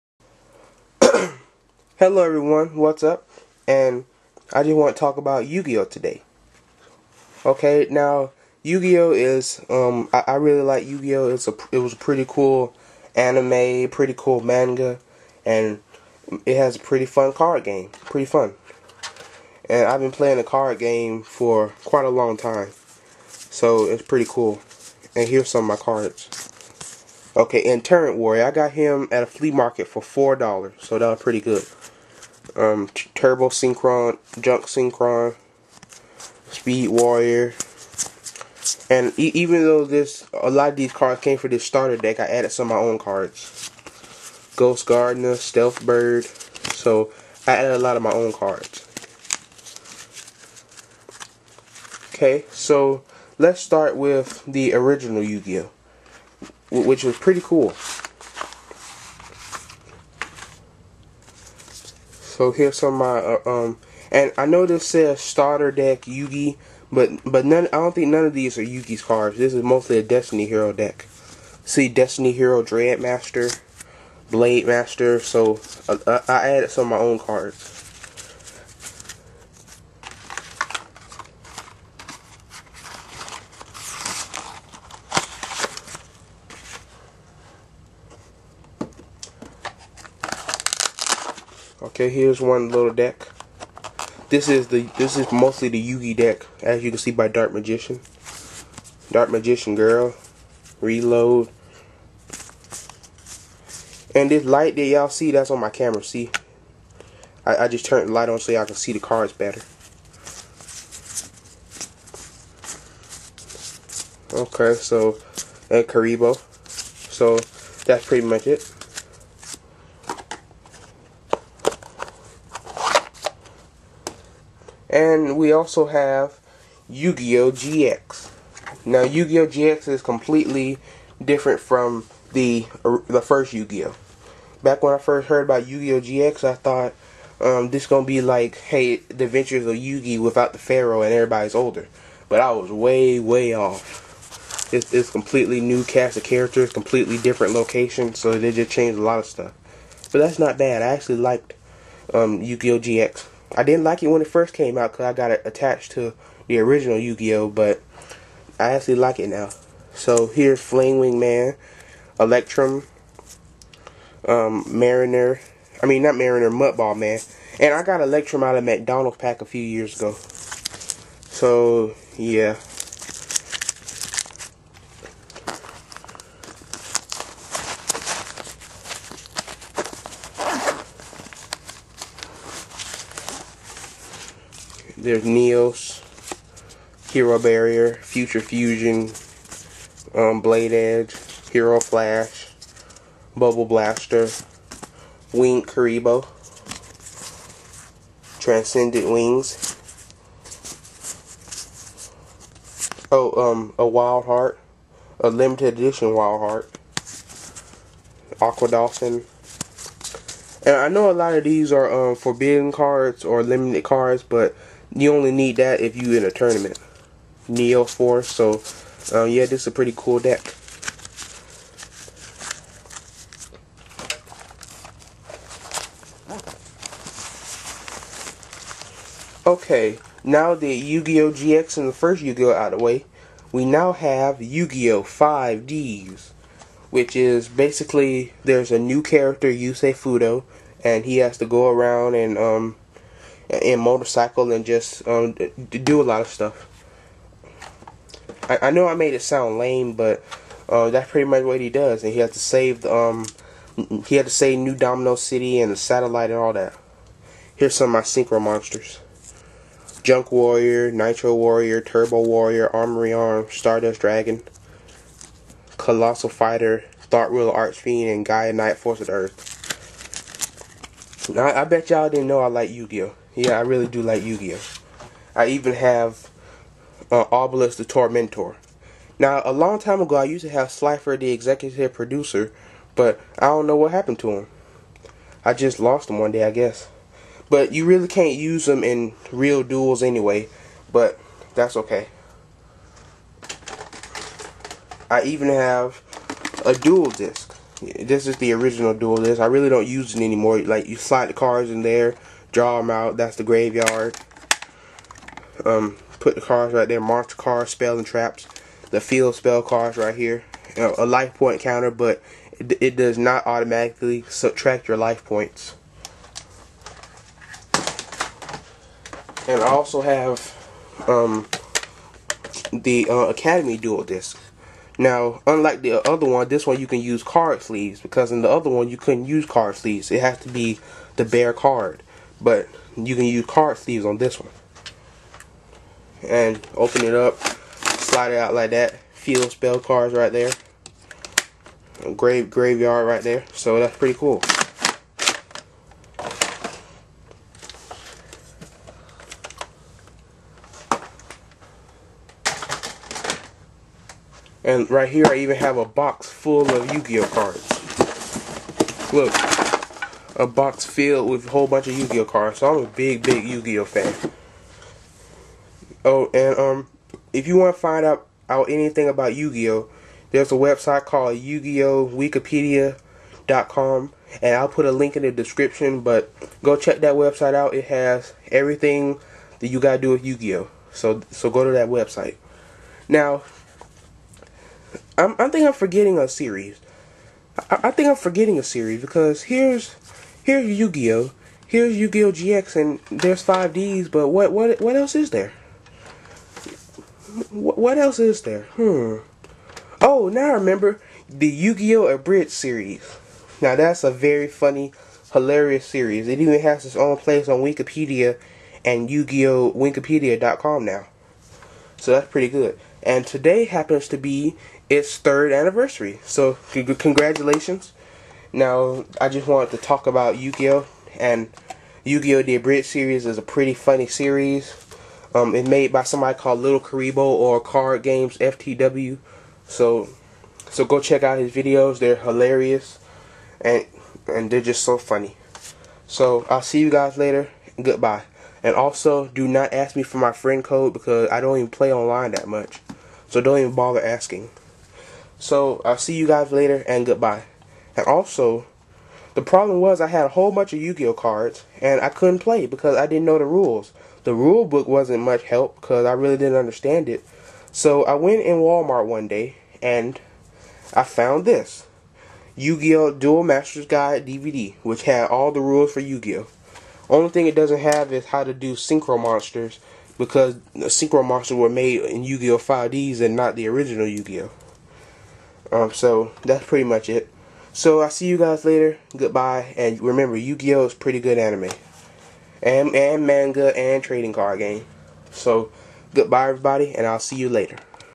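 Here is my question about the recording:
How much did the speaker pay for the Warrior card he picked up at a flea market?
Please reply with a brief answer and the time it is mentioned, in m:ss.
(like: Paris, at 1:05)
$4, at 0:30.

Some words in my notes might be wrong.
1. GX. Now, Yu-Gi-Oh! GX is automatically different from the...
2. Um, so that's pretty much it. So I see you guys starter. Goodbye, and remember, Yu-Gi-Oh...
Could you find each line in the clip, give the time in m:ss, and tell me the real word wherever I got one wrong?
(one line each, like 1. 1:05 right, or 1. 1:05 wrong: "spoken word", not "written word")
1. 2:07 wrong: "completely", not "automatically"
2. 7:55 wrong: "later", not "starter".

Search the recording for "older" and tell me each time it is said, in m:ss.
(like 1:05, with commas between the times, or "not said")
2:21.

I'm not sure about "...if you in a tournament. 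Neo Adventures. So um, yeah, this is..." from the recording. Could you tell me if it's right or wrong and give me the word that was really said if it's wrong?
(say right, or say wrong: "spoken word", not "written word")
wrong: "Force", not "Adventures".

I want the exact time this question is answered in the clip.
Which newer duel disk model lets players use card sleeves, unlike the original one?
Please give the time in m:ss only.
5:23.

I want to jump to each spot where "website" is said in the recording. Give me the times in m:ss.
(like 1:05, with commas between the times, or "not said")
6:10, 6:17, 6:21.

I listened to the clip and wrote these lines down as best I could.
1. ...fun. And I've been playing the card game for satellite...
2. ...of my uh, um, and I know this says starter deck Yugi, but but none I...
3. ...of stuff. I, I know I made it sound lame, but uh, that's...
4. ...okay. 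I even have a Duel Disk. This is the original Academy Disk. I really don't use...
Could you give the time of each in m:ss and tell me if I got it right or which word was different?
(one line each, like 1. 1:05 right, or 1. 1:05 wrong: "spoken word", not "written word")
1. 0:18 wrong: "quite", not "satellite"
2. 1:02 right
3. 4:06 right
4. 4:51 wrong: "Duel", not "Academy".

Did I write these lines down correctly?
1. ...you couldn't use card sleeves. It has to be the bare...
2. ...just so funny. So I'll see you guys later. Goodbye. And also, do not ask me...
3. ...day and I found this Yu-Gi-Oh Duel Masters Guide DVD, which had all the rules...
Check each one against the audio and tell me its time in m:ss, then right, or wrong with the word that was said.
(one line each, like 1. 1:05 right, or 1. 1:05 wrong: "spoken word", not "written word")
1. 5:28 right
2. 7:14 right
3. 7:39 right.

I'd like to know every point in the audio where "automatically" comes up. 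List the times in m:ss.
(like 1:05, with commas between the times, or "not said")
5:13.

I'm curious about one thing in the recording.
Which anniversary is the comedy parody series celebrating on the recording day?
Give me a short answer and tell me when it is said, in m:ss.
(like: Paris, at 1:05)
Third, at 6:55.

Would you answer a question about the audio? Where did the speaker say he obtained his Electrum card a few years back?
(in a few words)
McDonald's.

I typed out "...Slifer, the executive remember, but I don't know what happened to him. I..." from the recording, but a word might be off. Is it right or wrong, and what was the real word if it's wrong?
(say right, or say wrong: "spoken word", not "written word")
wrong: "producer", not "remember".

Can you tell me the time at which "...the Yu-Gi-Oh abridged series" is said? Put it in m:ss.
6:41.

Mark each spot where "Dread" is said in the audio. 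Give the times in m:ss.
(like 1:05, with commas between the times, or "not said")
1:12.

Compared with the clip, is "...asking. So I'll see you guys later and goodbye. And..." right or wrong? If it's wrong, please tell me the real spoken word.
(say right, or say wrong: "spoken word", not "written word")
right.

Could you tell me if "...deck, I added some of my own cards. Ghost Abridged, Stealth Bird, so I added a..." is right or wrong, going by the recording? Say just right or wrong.
wrong.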